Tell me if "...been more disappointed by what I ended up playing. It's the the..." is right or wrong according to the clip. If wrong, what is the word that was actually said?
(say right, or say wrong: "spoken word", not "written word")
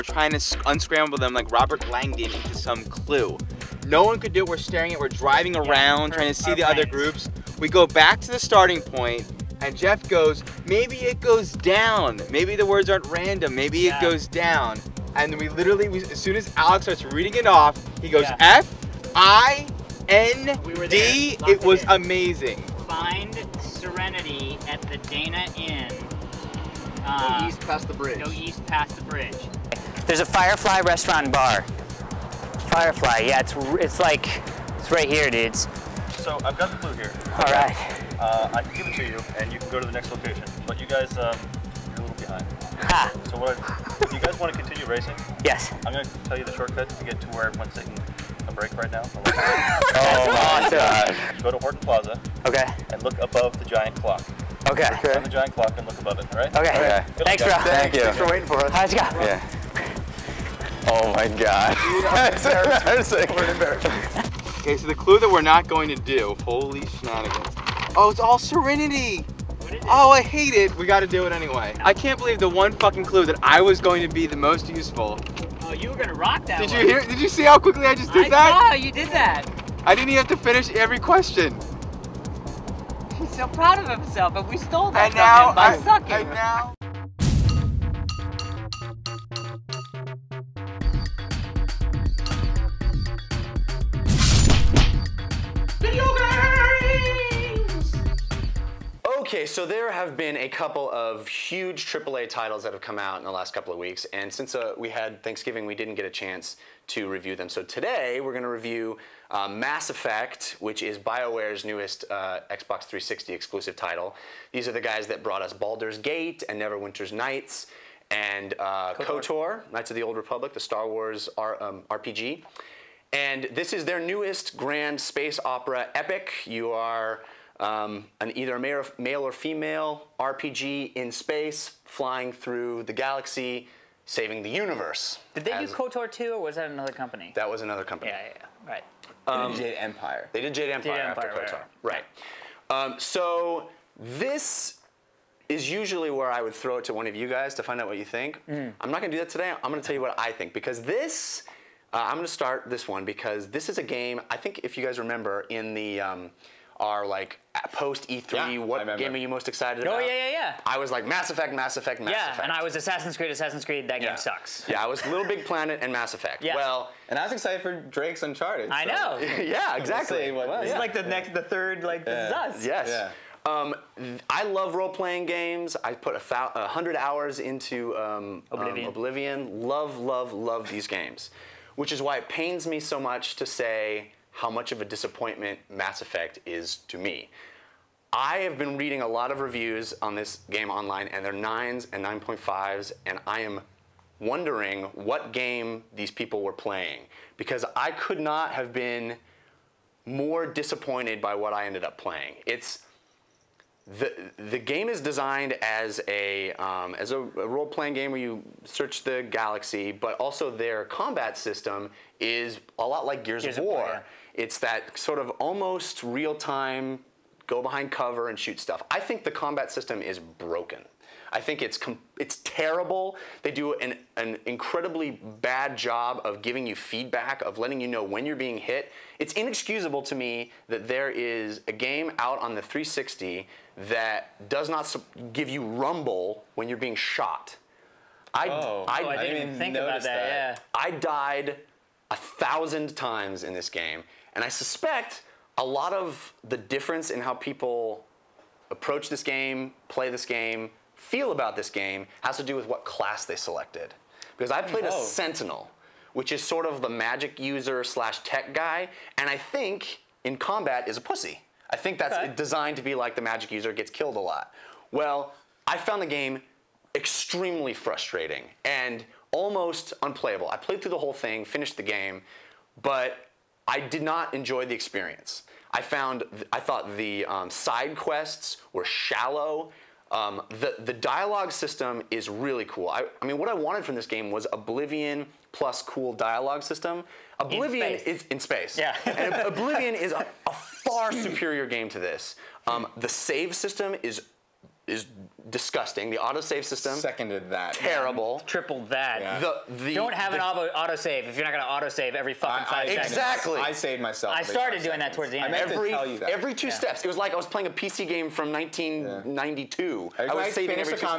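right.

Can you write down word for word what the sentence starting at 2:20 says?
They did Jade Empire, Jade Empire after Empire, KOTOR.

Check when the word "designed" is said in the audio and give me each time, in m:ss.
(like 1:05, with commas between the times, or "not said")
3:25, 4:22.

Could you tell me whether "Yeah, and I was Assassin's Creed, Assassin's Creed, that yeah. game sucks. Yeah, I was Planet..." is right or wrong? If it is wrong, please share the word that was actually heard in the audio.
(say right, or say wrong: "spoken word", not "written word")
wrong: "Little", not "Planet".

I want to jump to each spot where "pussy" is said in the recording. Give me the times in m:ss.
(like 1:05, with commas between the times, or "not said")
4:21.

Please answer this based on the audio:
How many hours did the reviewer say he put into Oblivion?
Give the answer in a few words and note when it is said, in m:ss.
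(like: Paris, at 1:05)
100, at 2:56.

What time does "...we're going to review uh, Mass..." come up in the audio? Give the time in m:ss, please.
1:48.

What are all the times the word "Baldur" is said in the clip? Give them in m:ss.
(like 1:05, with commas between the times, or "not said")
1:55.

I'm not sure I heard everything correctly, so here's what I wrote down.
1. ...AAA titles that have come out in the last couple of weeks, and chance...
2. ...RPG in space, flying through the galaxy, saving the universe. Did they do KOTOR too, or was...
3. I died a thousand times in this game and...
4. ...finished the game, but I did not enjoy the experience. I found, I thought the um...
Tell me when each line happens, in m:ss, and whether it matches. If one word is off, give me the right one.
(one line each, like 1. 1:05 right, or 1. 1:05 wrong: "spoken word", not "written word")
1. 1:41 wrong: "since", not "chance"
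2. 2:10 right
3. 4:00 right
4. 4:31 right.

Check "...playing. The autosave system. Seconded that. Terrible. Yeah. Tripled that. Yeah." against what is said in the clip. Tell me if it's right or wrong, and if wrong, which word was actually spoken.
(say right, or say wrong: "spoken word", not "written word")
wrong: "disgusting", not "playing".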